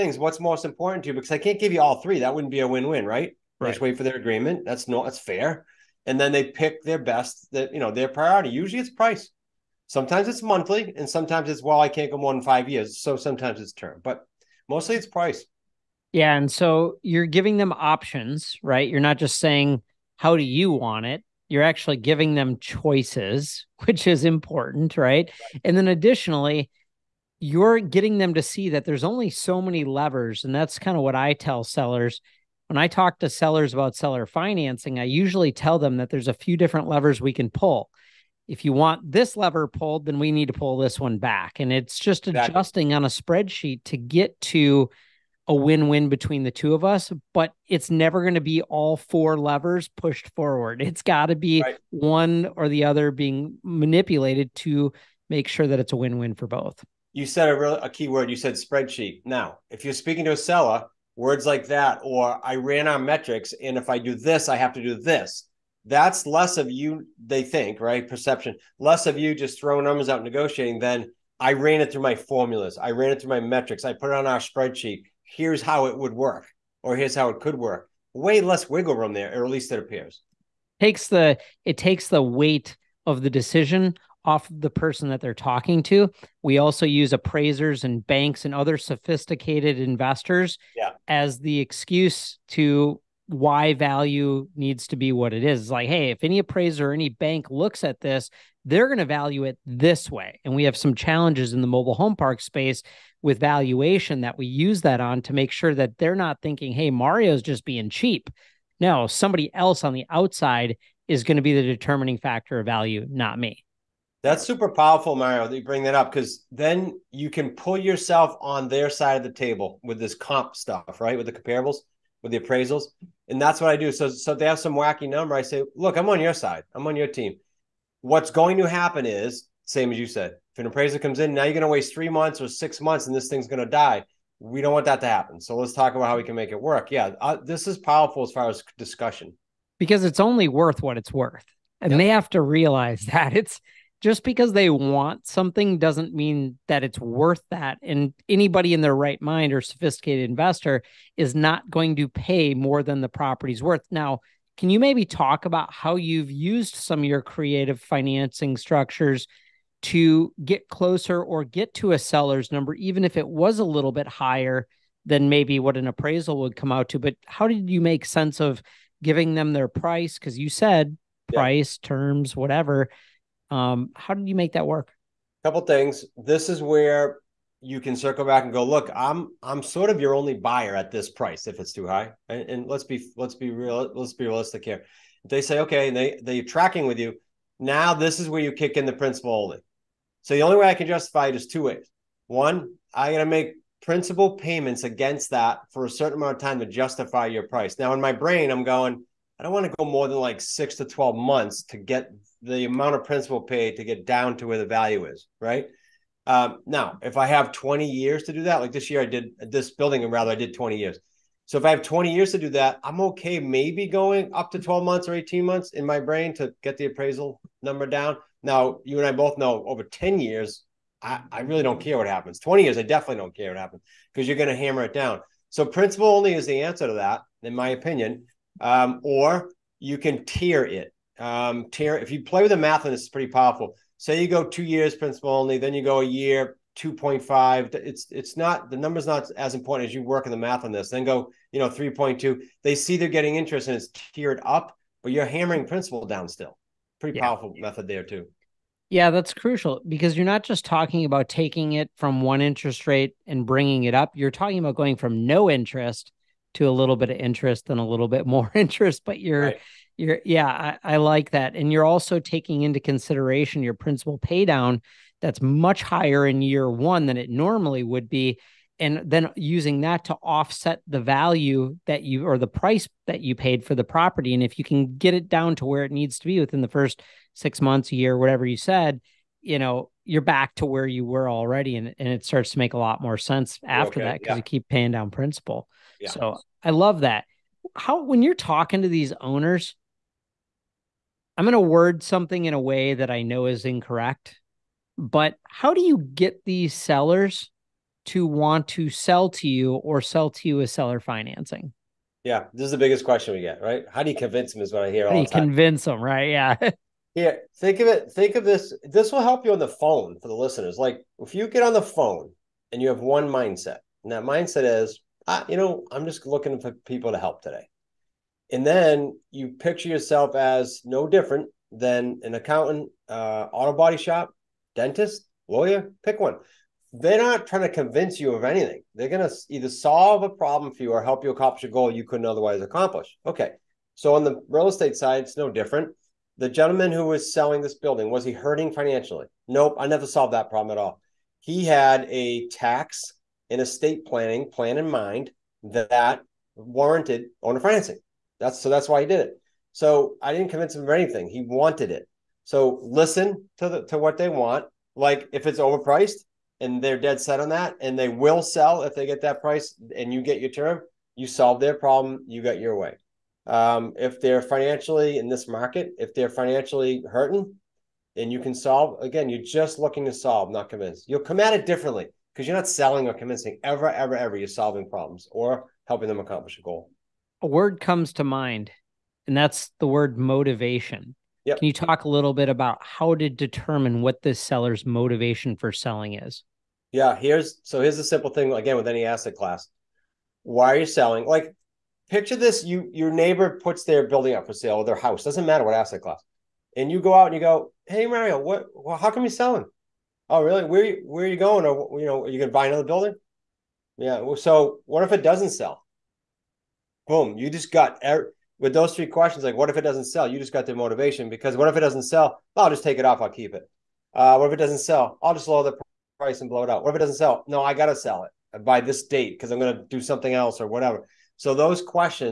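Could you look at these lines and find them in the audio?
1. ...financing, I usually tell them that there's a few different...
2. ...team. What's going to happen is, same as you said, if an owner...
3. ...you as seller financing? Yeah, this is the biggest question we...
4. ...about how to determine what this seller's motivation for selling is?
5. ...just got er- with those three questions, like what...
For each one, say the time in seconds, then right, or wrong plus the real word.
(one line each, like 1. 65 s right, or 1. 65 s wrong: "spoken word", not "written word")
1. 34 s right
2. 127 s wrong: "appraiser", not "owner"
3. 300 s right
4. 382 s right
5. 407 s right.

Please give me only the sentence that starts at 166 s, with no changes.
But how did you make sense of giving them their price?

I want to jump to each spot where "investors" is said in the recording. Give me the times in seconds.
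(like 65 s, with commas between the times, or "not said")
89 s, 150 s.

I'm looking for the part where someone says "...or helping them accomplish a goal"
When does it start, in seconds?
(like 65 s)
375 s.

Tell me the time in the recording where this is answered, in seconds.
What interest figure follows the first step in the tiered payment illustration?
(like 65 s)
241 s.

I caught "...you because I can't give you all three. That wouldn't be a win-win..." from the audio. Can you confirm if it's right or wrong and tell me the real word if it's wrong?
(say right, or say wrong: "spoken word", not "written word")
right.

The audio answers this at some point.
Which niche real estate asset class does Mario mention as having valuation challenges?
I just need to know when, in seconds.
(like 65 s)
101 s.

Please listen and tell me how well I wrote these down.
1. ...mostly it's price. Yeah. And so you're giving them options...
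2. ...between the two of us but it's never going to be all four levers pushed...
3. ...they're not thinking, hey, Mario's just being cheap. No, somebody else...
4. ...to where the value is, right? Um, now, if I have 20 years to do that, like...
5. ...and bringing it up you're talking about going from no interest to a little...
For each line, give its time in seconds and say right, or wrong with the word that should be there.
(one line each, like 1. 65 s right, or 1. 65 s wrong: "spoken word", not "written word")
1. 14 s right
2. 46 s right
3. 105 s right
4. 204 s right
5. 253 s right.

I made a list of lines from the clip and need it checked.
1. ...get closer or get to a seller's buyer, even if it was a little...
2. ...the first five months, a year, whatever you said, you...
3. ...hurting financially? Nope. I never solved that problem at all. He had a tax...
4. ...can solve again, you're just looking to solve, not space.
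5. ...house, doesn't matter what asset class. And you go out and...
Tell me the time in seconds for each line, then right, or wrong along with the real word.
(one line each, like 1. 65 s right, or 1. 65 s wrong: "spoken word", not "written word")
1. 160 s wrong: "number", not "buyer"
2. 276 s wrong: "six", not "five"
3. 338 s right
4. 368 s wrong: "convince", not "space"
5. 394 s right.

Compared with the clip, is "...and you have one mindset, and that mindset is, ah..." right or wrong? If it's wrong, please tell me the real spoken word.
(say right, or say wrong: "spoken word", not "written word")
right.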